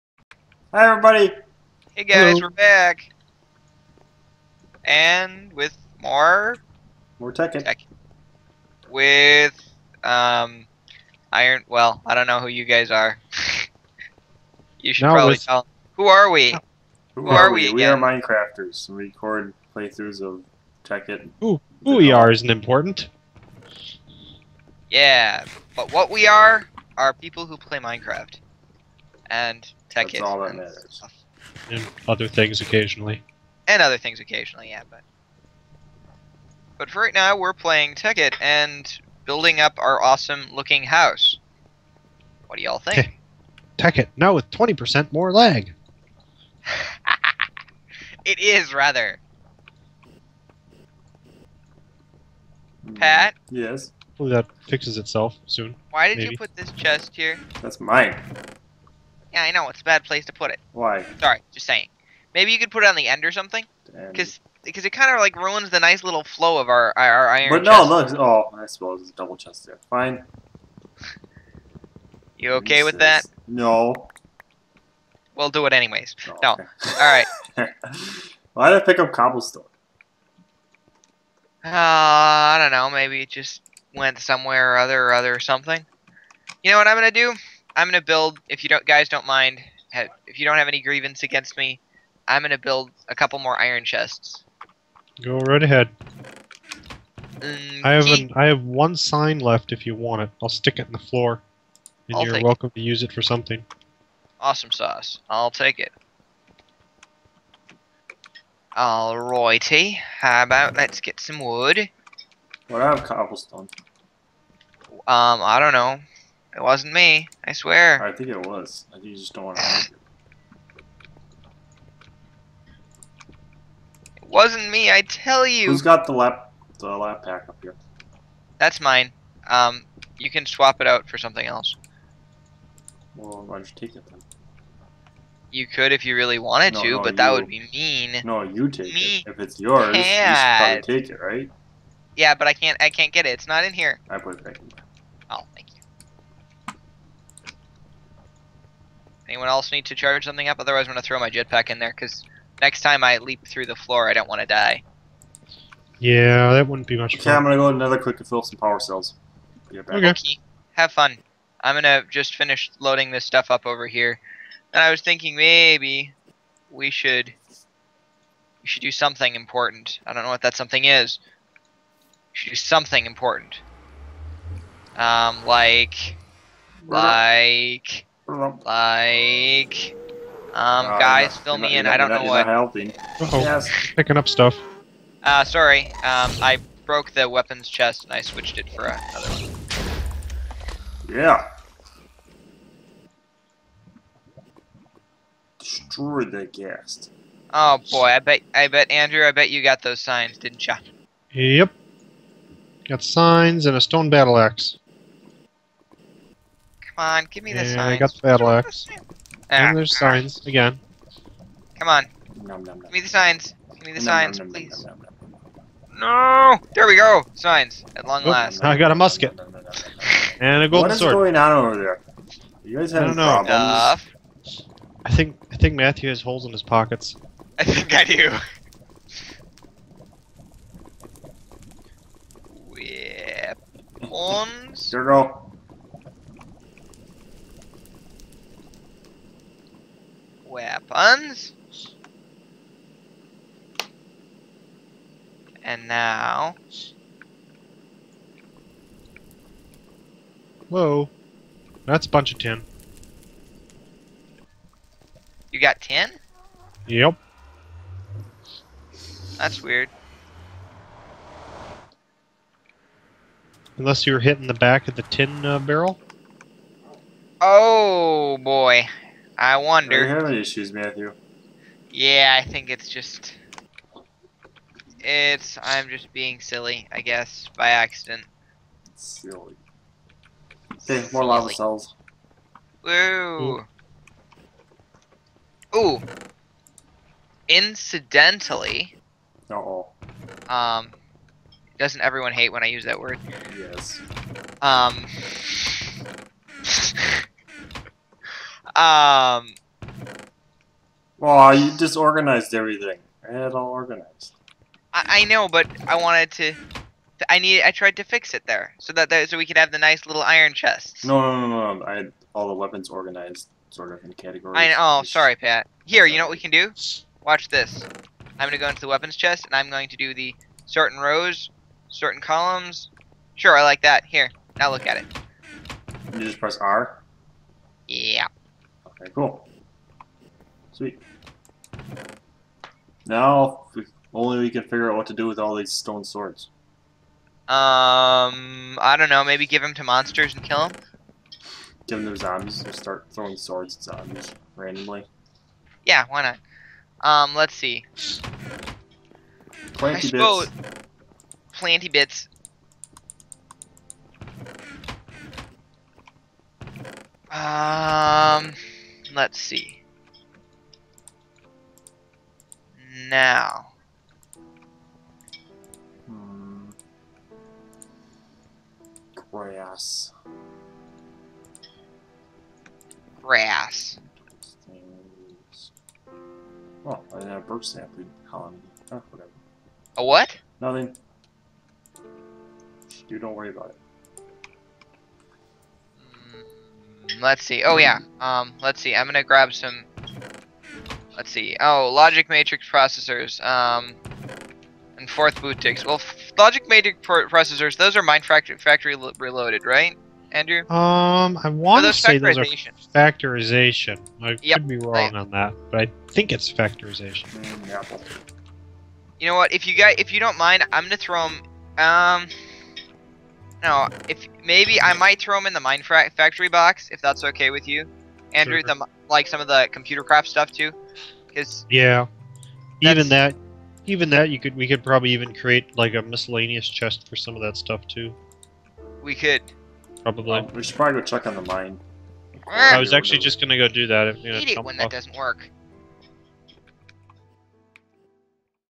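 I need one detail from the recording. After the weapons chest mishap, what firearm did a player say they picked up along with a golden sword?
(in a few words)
Musket.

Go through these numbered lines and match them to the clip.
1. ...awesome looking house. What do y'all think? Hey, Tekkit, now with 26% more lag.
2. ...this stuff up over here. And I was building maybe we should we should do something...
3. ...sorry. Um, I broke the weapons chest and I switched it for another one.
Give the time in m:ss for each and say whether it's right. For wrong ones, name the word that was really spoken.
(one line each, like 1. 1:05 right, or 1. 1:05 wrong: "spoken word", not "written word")
1. 0:40 wrong: "20", not "26"
2. 2:43 wrong: "thinking", not "building"
3. 3:05 right.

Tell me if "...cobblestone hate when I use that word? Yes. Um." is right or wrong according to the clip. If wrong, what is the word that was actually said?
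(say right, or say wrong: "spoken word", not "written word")
wrong: "everyone", not "cobblestone".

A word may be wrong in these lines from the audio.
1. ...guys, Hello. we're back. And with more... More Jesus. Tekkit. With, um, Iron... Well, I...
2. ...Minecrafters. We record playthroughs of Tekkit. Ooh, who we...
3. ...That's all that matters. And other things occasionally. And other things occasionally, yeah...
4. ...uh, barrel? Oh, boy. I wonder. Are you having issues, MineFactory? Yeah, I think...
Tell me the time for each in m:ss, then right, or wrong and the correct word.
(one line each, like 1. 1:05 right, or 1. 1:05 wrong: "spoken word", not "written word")
1. 0:02 wrong: "Tekkit", not "Jesus"
2. 0:17 right
3. 0:30 right
4. 4:25 wrong: "Matthew", not "MineFactory".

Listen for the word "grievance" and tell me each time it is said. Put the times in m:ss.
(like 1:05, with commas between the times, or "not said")
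1:30.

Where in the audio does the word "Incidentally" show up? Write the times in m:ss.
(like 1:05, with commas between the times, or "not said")
4:47.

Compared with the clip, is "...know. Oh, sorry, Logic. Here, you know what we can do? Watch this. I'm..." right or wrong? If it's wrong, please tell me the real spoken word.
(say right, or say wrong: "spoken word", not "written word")
wrong: "Pat", not "Logic".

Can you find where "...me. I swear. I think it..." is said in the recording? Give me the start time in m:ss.
1:56.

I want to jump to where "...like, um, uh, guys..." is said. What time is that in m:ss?
2:58.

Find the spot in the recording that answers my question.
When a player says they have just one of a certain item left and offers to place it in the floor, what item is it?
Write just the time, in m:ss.
1:38.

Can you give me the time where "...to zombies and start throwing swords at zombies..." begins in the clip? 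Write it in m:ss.
5:42.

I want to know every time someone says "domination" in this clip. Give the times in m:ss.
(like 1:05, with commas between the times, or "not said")
not said.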